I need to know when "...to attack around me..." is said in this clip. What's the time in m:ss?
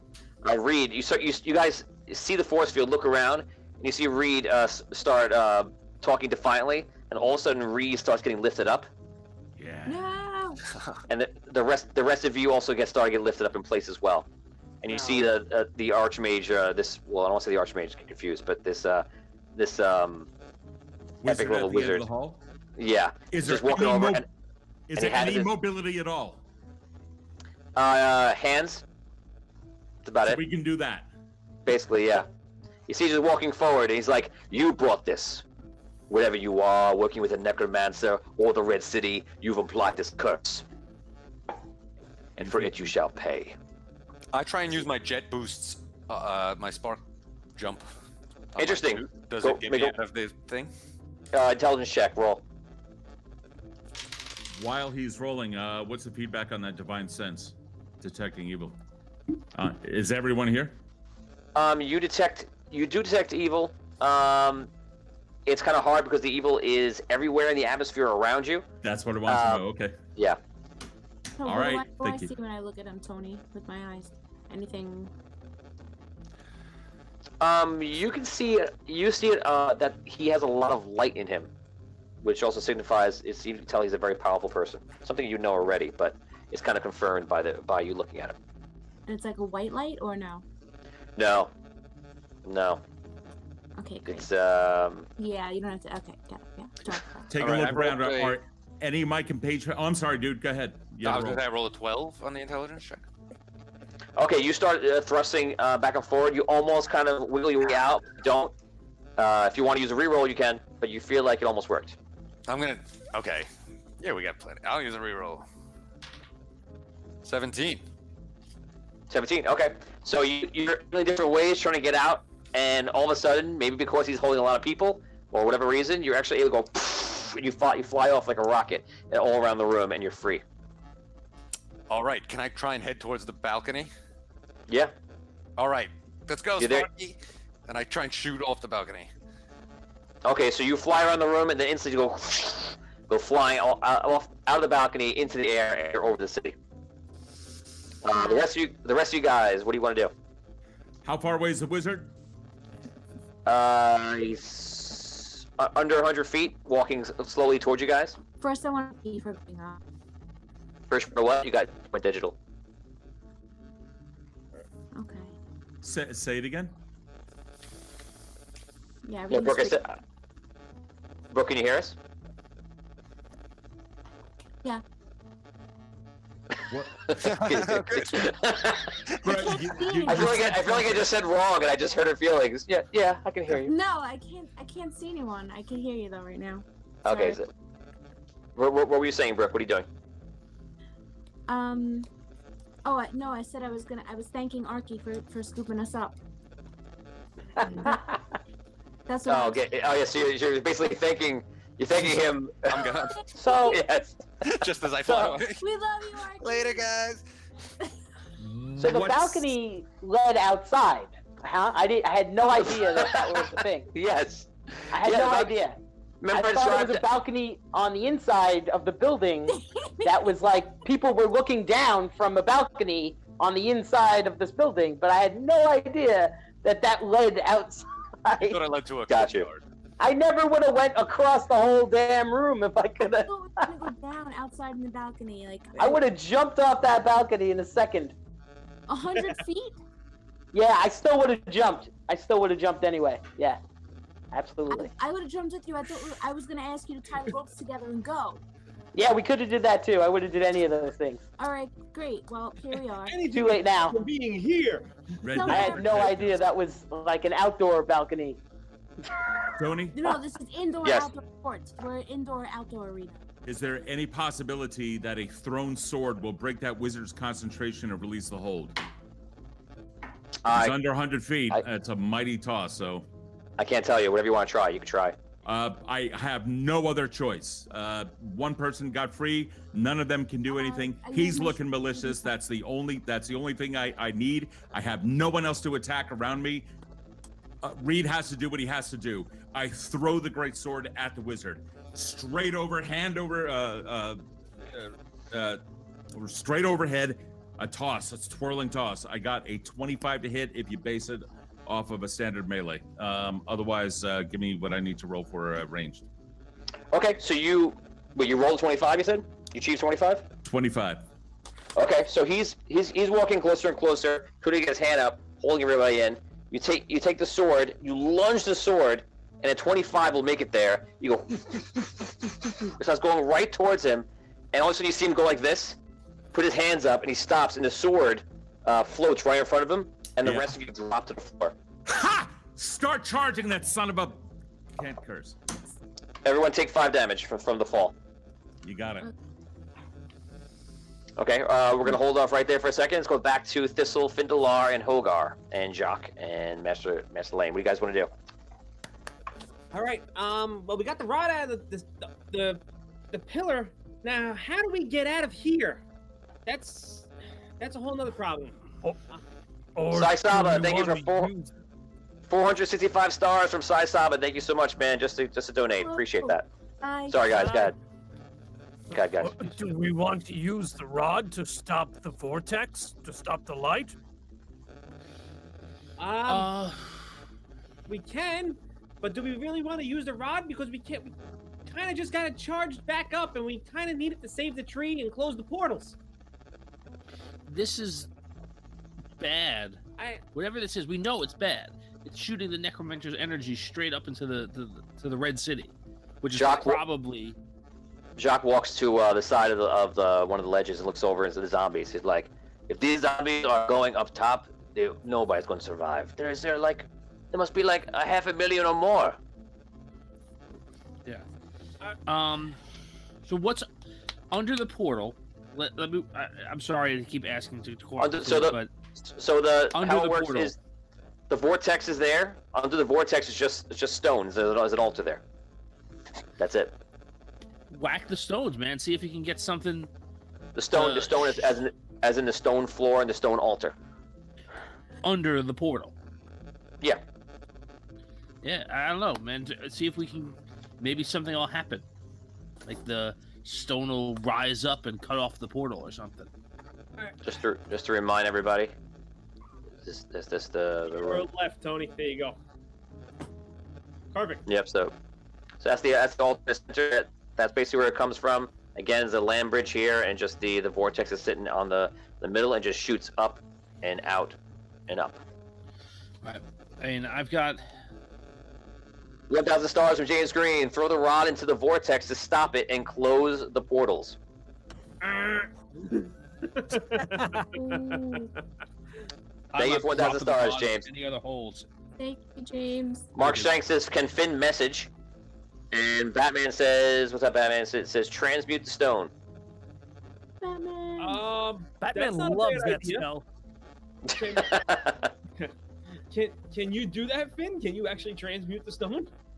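4:45.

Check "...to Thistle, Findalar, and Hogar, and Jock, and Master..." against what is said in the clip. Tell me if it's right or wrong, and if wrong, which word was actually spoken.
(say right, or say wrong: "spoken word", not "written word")
right.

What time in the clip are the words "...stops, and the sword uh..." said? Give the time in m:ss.
5:27.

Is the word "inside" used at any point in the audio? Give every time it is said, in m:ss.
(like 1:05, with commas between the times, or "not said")
3:38, 3:43.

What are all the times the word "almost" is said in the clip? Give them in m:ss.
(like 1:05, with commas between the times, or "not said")
1:46, 1:51.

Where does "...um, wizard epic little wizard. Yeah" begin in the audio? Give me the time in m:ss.
0:19.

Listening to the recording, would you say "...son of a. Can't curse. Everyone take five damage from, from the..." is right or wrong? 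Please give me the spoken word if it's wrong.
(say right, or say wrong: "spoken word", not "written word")
right.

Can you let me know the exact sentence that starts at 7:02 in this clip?
Under the vortex is just just stones.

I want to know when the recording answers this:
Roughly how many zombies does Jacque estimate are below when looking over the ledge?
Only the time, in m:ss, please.
6:48.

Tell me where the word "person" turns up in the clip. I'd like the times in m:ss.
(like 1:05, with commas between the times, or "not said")
1:24, 4:38.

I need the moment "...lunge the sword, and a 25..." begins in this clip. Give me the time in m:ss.
5:17.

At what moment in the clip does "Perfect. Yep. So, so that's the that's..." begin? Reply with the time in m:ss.
7:34.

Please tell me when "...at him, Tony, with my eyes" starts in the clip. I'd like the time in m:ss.
1:12.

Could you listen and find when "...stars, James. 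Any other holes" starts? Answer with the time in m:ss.
8:00.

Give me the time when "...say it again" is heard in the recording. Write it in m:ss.
2:46.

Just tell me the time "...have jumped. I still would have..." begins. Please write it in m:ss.
4:01.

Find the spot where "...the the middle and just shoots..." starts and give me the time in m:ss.
7:41.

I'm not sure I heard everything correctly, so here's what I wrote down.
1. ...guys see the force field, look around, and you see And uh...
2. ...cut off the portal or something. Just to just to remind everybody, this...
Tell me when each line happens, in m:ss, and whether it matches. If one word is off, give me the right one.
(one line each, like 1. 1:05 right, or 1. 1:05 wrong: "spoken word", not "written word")
1. 0:01 wrong: "Reed", not "And"
2. 7:25 right.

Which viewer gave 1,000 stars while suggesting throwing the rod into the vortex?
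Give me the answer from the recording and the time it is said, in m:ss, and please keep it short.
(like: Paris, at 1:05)
James Green, at 7:50.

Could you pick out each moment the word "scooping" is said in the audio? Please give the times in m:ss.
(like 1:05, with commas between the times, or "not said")
3:15.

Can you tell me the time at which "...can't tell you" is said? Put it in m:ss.
4:33.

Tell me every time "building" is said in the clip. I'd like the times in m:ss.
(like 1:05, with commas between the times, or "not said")
3:38, 3:44.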